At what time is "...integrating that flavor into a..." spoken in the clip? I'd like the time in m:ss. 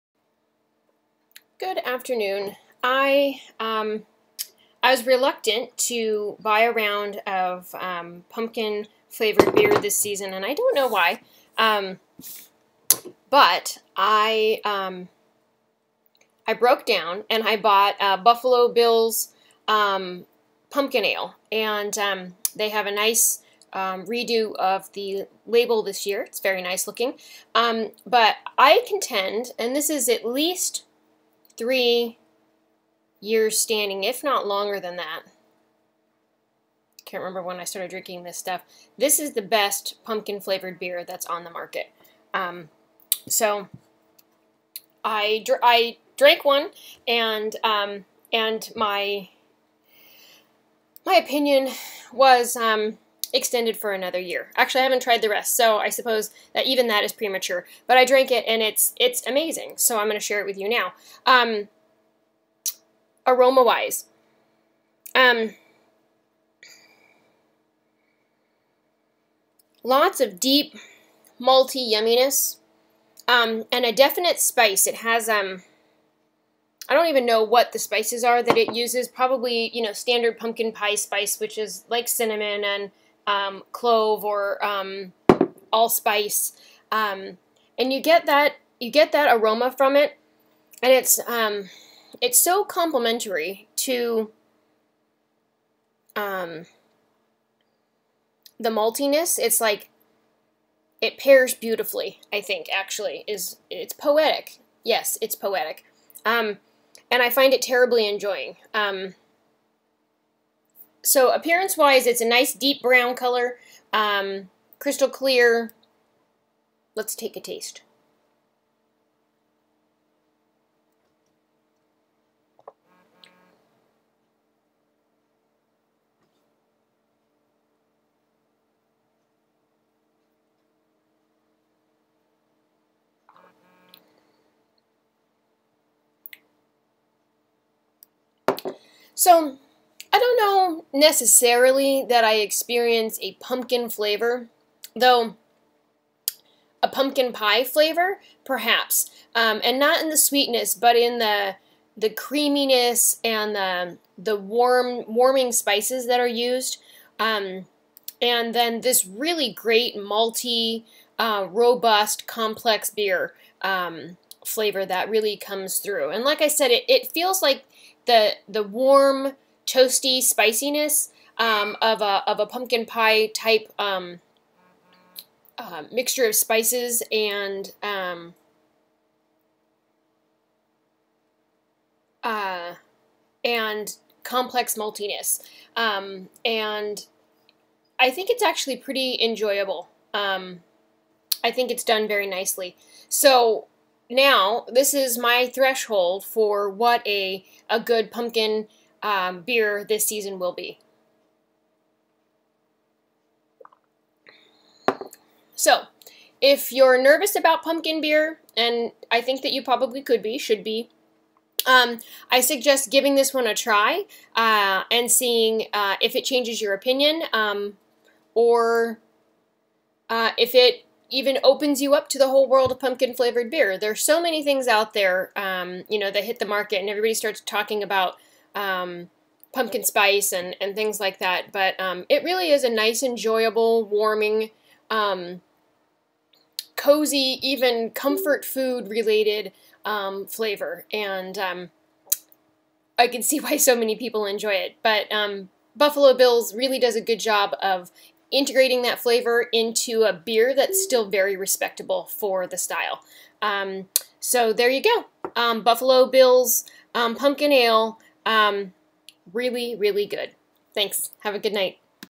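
4:08.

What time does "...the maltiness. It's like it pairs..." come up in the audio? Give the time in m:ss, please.
1:38.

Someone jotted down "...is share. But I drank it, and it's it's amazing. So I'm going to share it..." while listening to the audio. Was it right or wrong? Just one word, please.
wrong.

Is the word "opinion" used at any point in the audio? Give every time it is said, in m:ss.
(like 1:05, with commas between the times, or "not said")
0:51, 3:36.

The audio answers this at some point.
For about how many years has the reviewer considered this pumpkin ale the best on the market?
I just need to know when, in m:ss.
0:31.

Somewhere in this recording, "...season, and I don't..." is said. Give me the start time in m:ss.
0:09.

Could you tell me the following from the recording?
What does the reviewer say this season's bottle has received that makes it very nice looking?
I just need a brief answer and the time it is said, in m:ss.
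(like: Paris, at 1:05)
redo of the label, at 0:24.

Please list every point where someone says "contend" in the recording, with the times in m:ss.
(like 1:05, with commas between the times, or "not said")
0:28.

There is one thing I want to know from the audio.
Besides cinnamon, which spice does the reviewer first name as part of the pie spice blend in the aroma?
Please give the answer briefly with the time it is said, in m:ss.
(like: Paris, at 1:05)
clove, at 1:23.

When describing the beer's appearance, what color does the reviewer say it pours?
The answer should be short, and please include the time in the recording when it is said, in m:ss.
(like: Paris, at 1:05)
deep brown, at 1:52.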